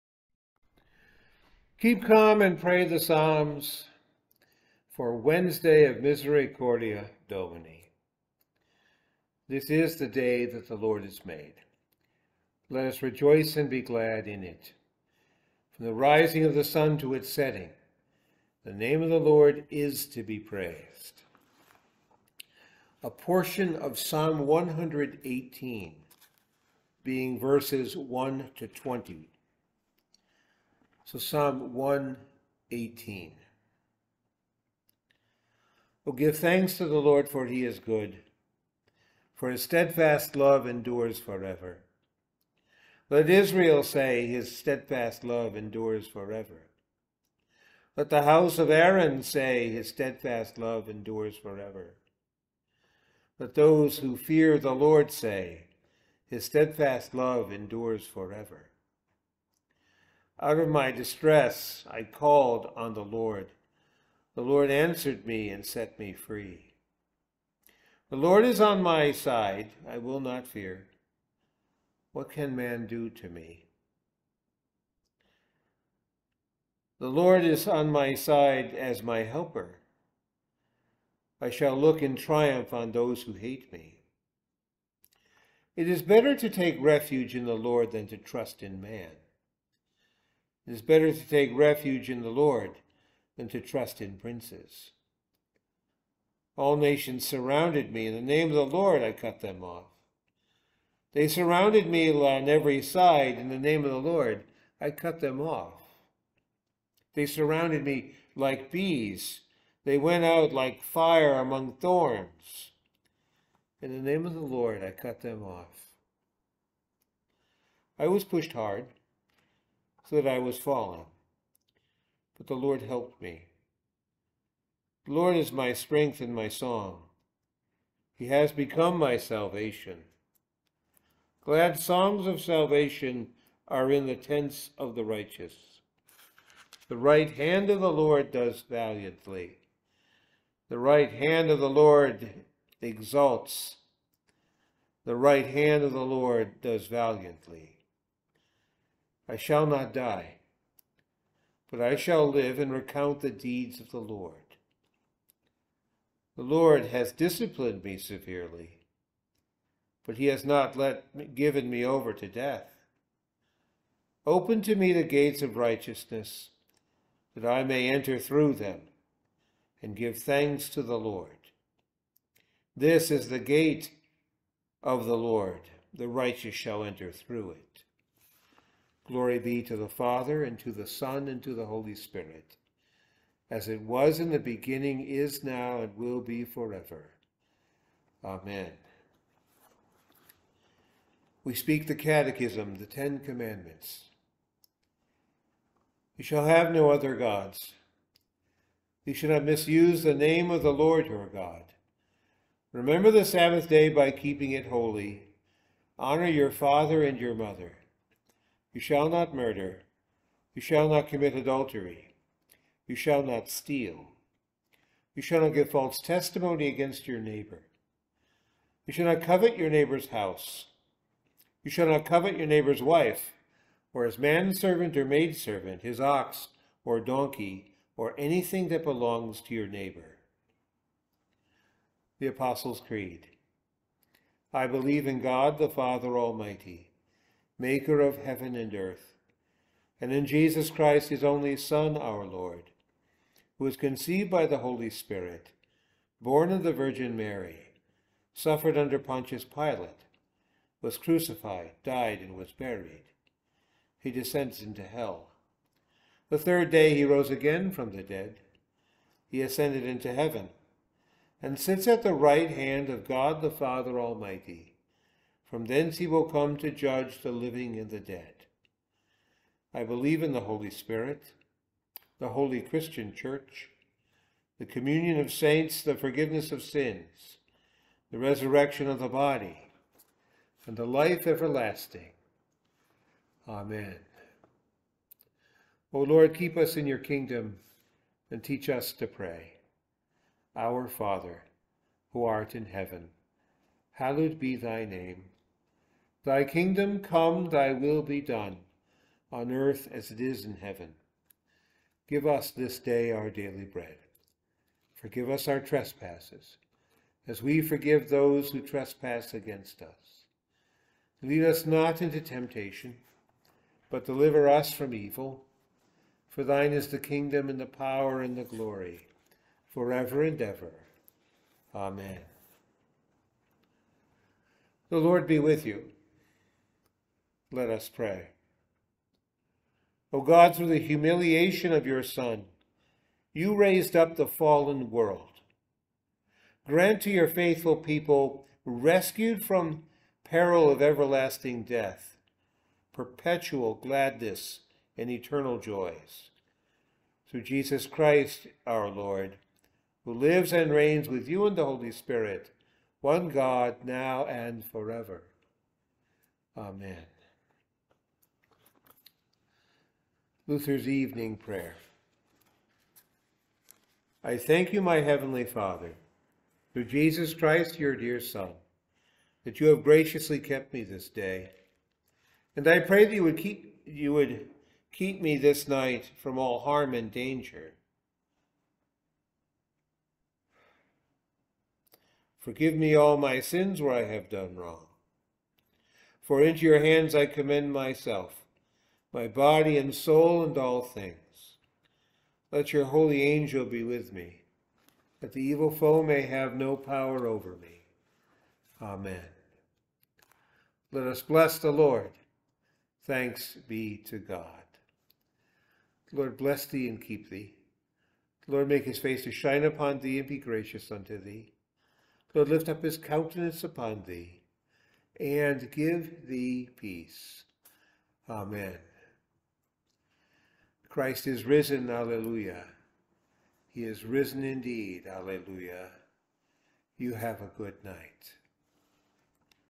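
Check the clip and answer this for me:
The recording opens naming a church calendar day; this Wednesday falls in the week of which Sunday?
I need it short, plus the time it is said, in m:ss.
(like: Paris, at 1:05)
Misericordia Domini, at 0:06.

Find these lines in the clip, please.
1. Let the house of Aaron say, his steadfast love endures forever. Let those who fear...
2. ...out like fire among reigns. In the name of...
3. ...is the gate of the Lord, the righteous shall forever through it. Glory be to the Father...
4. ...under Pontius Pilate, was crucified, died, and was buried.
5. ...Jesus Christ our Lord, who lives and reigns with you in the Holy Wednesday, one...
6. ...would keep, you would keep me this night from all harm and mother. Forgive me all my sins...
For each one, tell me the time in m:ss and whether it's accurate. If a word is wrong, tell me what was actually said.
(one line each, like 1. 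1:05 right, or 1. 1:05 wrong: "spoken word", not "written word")
1. 0:47 right
2. 1:50 wrong: "thorns", not "reigns"
3. 2:53 wrong: "enter", not "forever"
4. 4:08 right
5. 5:47 wrong: "Spirit", not "Wednesday"
6. 6:13 wrong: "danger", not "mother".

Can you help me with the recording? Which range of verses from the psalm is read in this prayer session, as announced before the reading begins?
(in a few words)
1 to 20.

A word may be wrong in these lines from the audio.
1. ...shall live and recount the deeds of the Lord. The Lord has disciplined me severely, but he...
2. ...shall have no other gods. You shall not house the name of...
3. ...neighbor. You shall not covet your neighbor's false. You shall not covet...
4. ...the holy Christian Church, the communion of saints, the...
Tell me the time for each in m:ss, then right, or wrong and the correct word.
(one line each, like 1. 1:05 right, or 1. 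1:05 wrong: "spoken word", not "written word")
1. 2:31 right
2. 3:16 wrong: "misuse", not "house"
3. 3:37 wrong: "house", not "false"
4. 4:32 right.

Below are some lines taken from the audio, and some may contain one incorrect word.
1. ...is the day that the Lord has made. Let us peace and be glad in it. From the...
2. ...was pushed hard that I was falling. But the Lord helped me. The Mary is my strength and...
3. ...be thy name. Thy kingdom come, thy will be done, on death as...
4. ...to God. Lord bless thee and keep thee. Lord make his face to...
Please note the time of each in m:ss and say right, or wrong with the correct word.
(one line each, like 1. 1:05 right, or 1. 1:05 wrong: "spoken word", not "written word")
1. 0:09 wrong: "rejoice", not "peace"
2. 1:58 wrong: "Lord", not "Mary"
3. 4:54 wrong: "earth", not "death"
4. 6:44 right.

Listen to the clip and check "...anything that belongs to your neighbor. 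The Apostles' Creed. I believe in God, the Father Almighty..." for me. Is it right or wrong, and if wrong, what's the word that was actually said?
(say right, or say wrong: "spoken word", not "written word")
right.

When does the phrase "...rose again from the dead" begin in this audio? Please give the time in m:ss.
4:17.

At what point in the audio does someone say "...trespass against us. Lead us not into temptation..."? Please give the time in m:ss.
5:08.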